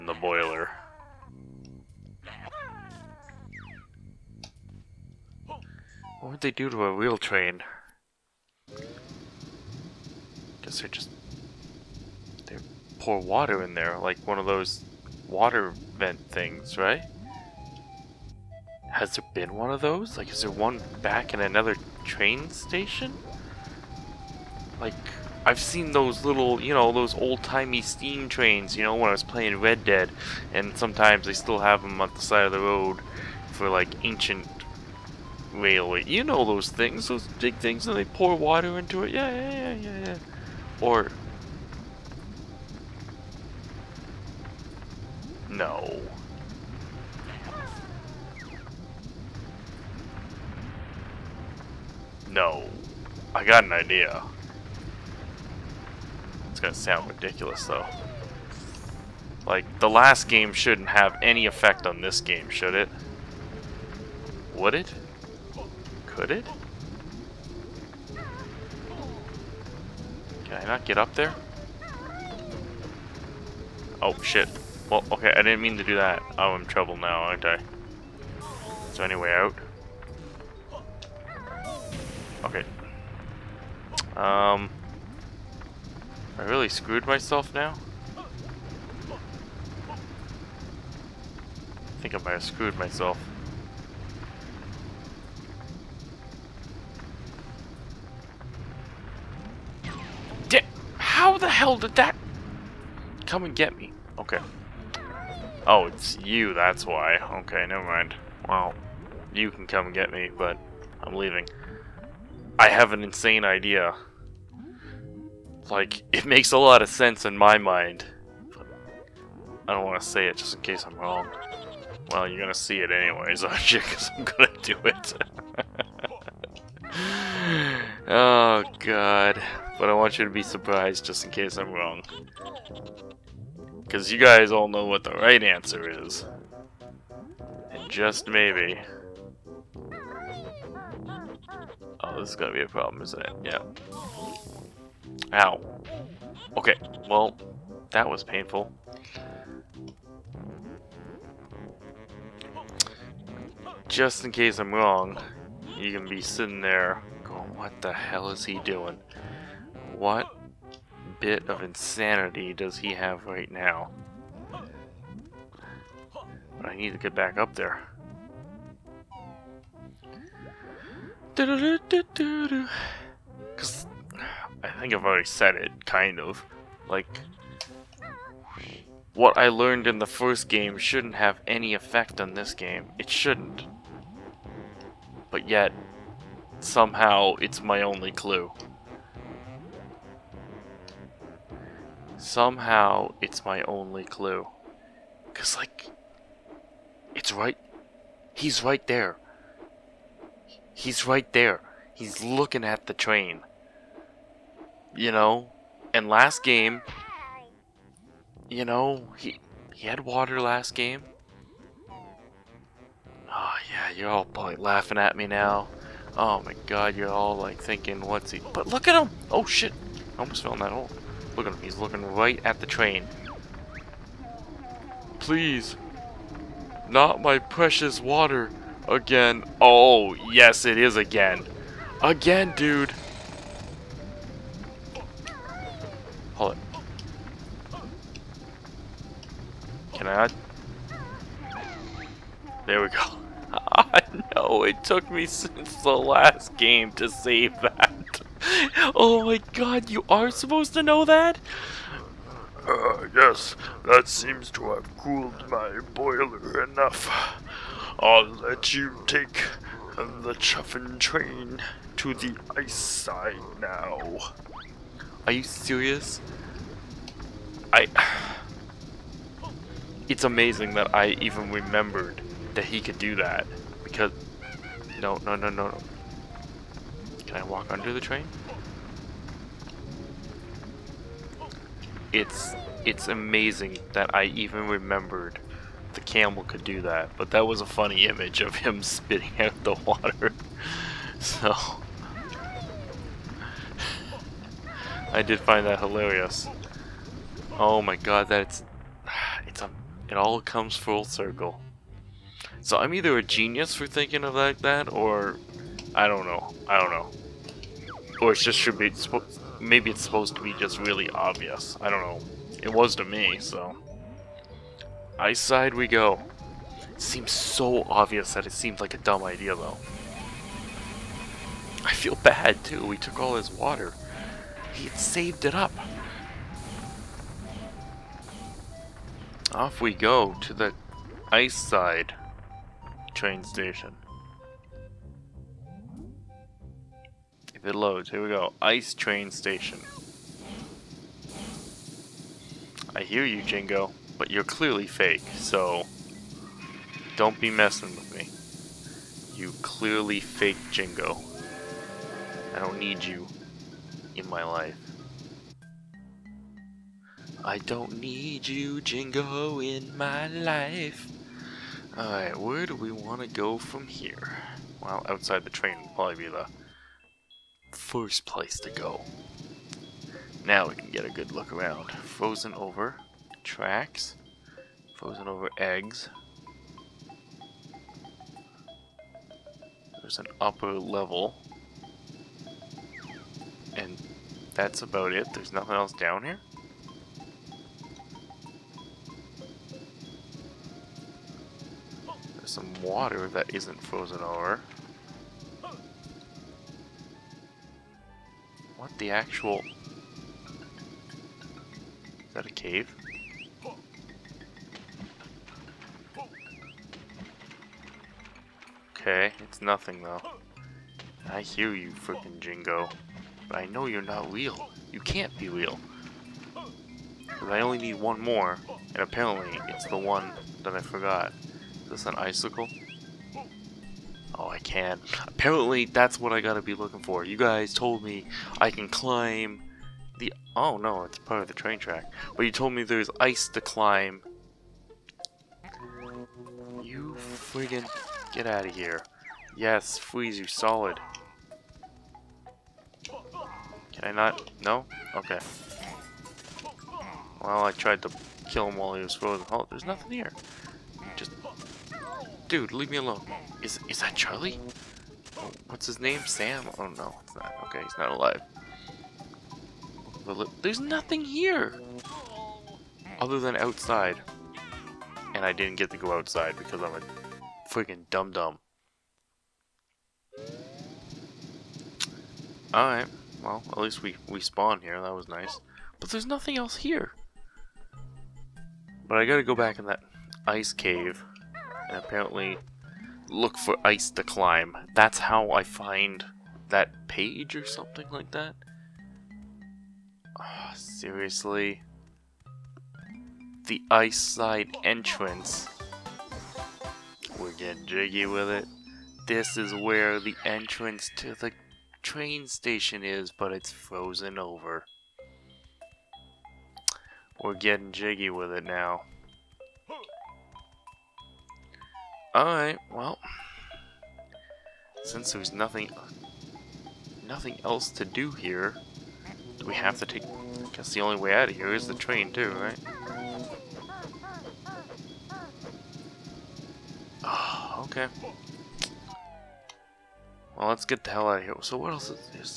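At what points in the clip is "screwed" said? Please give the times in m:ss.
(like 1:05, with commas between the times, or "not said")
1:26, 1:32.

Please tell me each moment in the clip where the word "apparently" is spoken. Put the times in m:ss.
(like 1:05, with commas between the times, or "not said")
6:58, 7:05, 8:01.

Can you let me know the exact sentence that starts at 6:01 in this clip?
Alright, where do we want to go from here?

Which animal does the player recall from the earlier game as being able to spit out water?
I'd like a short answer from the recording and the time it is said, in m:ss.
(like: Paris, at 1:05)
camel, at 4:46.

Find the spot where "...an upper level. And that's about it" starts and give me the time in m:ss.
6:20.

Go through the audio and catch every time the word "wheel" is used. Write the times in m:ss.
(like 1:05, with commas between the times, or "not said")
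0:06.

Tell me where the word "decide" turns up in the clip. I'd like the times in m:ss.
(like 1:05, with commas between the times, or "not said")
not said.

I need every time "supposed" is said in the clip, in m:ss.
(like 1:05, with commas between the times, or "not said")
4:10, 5:10.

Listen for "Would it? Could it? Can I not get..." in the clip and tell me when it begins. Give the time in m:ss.
1:04.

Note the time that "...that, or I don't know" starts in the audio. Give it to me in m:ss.
5:04.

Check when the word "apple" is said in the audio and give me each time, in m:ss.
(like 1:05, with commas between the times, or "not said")
not said.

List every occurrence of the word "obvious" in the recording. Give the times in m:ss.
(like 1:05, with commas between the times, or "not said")
5:11, 5:17.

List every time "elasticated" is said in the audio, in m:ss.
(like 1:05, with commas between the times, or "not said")
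not said.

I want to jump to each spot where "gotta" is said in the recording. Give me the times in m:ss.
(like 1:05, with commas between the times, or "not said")
7:06, 7:59.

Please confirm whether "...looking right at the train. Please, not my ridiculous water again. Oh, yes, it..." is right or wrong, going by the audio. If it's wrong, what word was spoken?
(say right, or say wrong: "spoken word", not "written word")
wrong: "precious", not "ridiculous".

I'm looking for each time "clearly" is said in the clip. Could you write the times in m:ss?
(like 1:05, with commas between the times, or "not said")
5:44, 5:49.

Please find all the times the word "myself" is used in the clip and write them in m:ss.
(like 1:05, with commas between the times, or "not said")
1:27, 1:32.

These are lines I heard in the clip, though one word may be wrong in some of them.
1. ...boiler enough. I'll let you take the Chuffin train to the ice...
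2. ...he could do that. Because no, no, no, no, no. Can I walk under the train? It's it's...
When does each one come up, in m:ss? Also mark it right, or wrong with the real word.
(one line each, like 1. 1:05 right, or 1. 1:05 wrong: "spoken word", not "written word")
1. 4:15 right
2. 4:32 right.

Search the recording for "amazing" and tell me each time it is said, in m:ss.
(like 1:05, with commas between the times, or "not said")
4:30, 4:43.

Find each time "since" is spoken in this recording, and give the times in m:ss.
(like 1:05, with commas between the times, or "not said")
4:05, 8:35.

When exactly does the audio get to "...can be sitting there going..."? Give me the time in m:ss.
2:35.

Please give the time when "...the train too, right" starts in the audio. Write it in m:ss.
8:41.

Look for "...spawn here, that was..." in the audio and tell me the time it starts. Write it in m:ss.
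7:54.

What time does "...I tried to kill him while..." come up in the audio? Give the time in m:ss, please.
7:27.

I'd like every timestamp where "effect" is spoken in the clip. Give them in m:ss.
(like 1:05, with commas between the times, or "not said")
1:01, 3:01.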